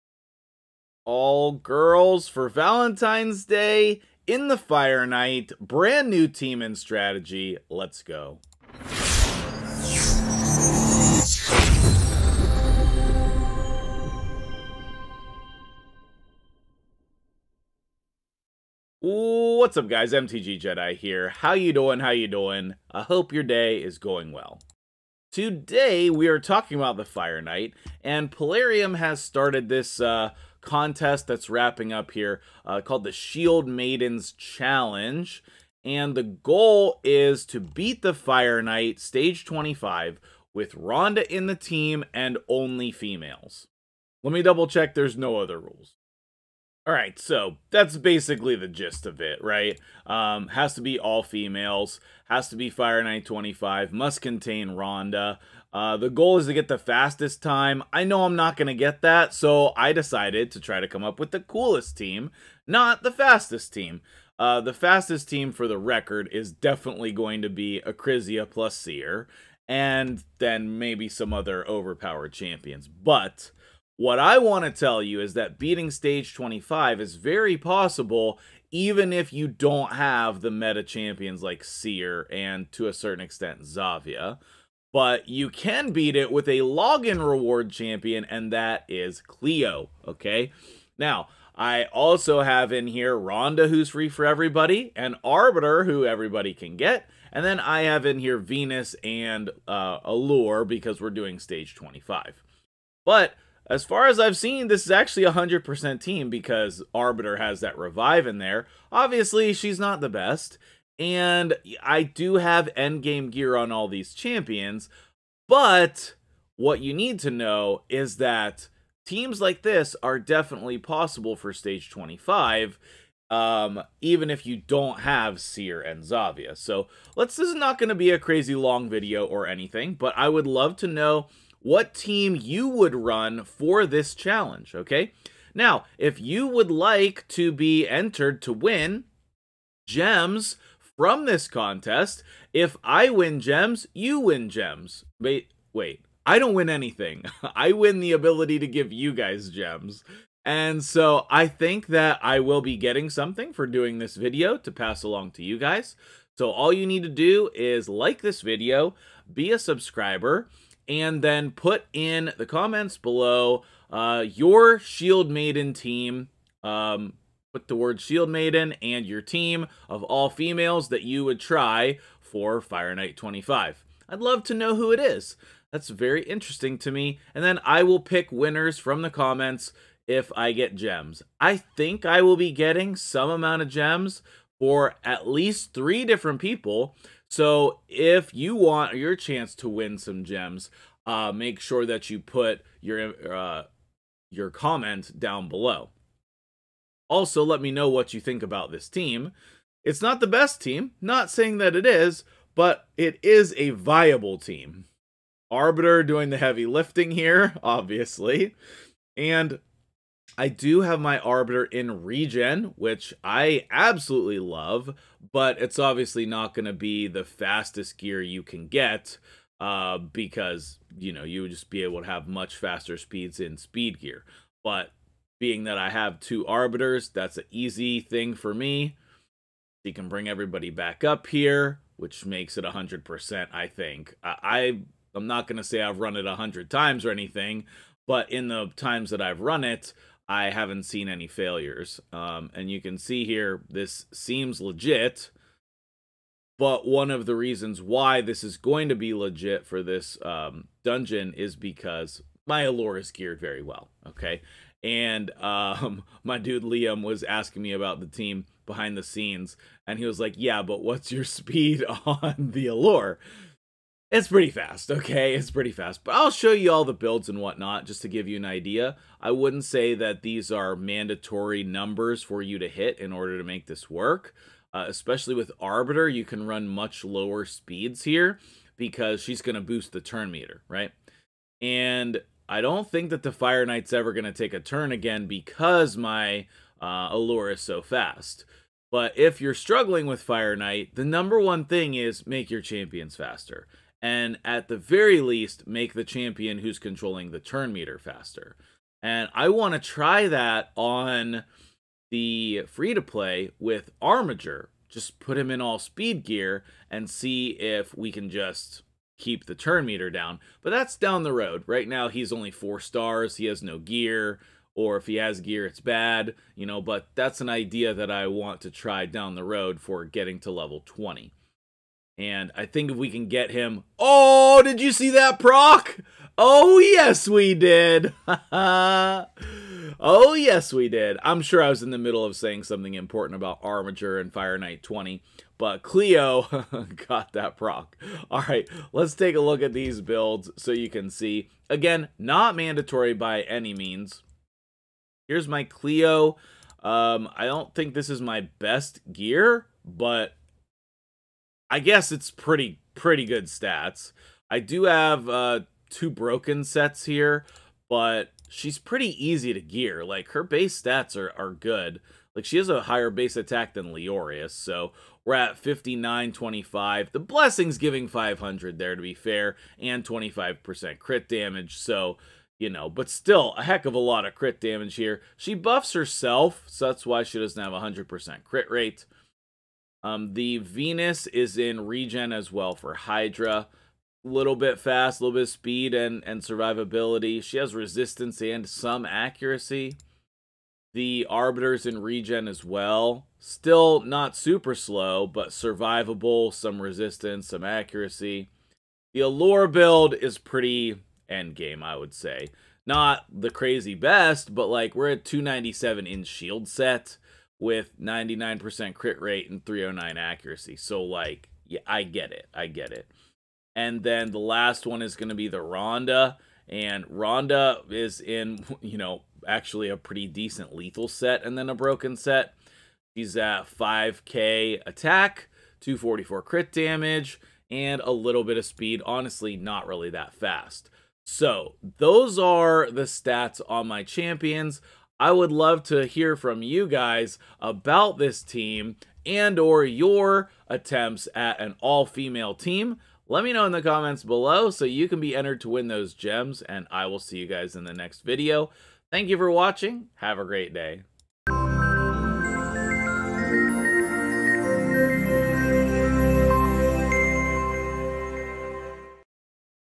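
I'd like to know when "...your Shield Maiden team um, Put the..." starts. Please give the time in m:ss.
2:44.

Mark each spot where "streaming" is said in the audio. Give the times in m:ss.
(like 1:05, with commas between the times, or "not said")
not said.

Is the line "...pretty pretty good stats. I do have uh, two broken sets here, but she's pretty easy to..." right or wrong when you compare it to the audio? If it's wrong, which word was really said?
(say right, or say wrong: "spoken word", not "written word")
right.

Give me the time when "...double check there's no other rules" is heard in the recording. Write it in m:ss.
0:44.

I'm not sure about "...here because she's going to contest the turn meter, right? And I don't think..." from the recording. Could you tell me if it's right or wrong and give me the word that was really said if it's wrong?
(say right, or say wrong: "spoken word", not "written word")
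wrong: "boost", not "contest".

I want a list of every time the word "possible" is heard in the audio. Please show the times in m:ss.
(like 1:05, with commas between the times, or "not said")
1:17, 2:00.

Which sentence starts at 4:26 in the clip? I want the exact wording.
But I'll show you all the builds and whatnot just to give you an idea.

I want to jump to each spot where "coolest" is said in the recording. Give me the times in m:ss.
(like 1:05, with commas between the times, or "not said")
1:01.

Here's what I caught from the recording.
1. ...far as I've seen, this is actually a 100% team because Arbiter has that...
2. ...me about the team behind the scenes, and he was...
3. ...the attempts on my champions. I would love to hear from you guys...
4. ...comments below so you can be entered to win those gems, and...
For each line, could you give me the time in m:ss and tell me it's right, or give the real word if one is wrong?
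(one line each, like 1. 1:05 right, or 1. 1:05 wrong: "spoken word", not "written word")
1. 1:43 right
2. 4:17 right
3. 7:12 wrong: "stats", not "attempts"
4. 7:23 right.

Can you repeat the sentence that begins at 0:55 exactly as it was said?
Uh, the goal is to get the fastest time.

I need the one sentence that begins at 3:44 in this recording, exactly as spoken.
But being that I have two arbiters, that's an easy thing for me.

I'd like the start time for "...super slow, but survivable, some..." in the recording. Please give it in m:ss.
6:34.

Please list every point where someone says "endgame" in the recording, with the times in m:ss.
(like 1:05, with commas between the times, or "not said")
1:52, 6:41.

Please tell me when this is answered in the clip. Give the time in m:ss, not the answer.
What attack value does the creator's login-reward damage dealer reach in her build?
6:05.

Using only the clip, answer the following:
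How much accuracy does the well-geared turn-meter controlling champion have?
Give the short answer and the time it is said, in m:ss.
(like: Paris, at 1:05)
309, at 6:49.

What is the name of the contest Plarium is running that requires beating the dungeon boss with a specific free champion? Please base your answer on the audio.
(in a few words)
Shield Maidens Challenge.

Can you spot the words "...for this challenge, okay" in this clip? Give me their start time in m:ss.
2:13.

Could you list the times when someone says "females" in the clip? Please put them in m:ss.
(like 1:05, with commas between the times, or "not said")
0:42, 0:51, 2:50, 7:21.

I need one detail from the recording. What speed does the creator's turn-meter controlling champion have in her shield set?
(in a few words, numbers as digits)
297.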